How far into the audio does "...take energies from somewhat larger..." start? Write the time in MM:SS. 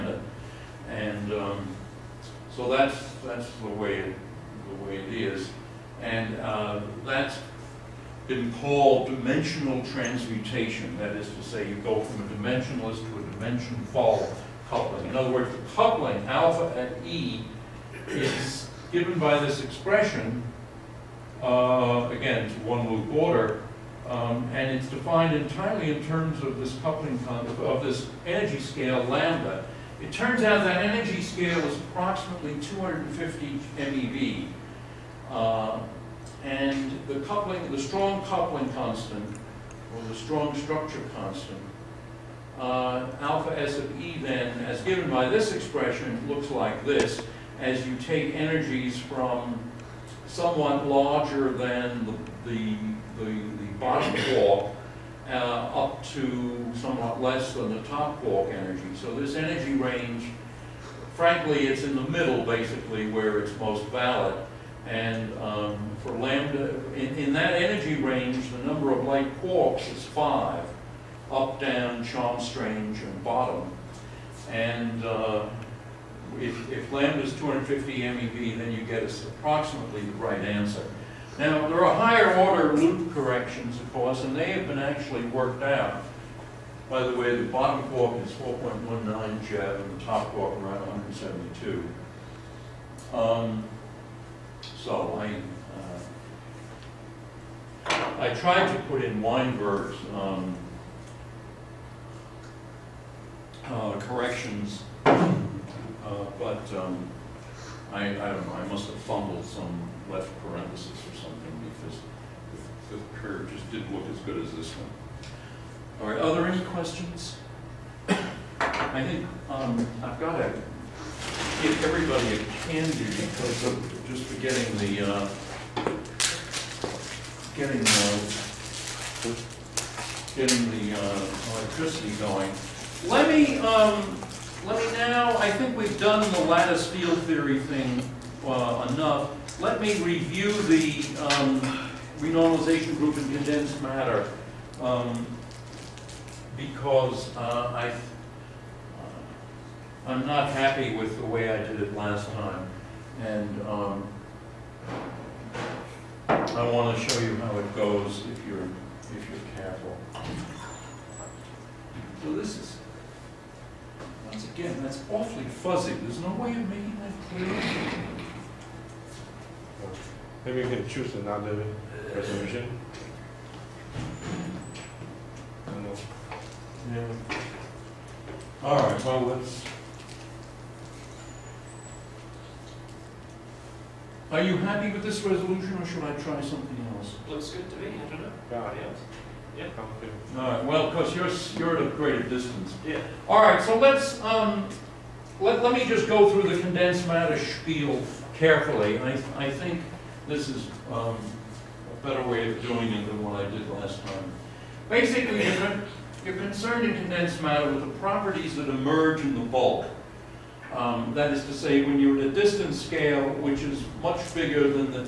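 00:47.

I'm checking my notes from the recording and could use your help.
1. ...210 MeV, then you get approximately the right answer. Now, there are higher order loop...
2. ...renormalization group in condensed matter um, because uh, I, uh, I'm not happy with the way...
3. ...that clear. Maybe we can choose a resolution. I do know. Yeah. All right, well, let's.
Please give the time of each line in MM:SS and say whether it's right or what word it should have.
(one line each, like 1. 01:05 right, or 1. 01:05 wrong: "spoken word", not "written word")
1. 01:17 wrong: "250", not "210"
2. 02:22 right
3. 02:47 right.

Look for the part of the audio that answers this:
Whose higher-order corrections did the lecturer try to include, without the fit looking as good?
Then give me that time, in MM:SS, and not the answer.
01:39.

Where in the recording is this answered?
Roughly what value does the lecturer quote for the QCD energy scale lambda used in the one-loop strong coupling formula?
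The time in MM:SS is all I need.
00:31.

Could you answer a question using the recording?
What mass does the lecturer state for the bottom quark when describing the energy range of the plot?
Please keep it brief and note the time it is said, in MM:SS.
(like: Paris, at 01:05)
4.19 GeV, at 01:28.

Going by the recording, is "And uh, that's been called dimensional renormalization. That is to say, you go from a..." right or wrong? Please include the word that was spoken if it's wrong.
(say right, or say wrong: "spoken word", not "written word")
wrong: "transmutation", not "renormalization".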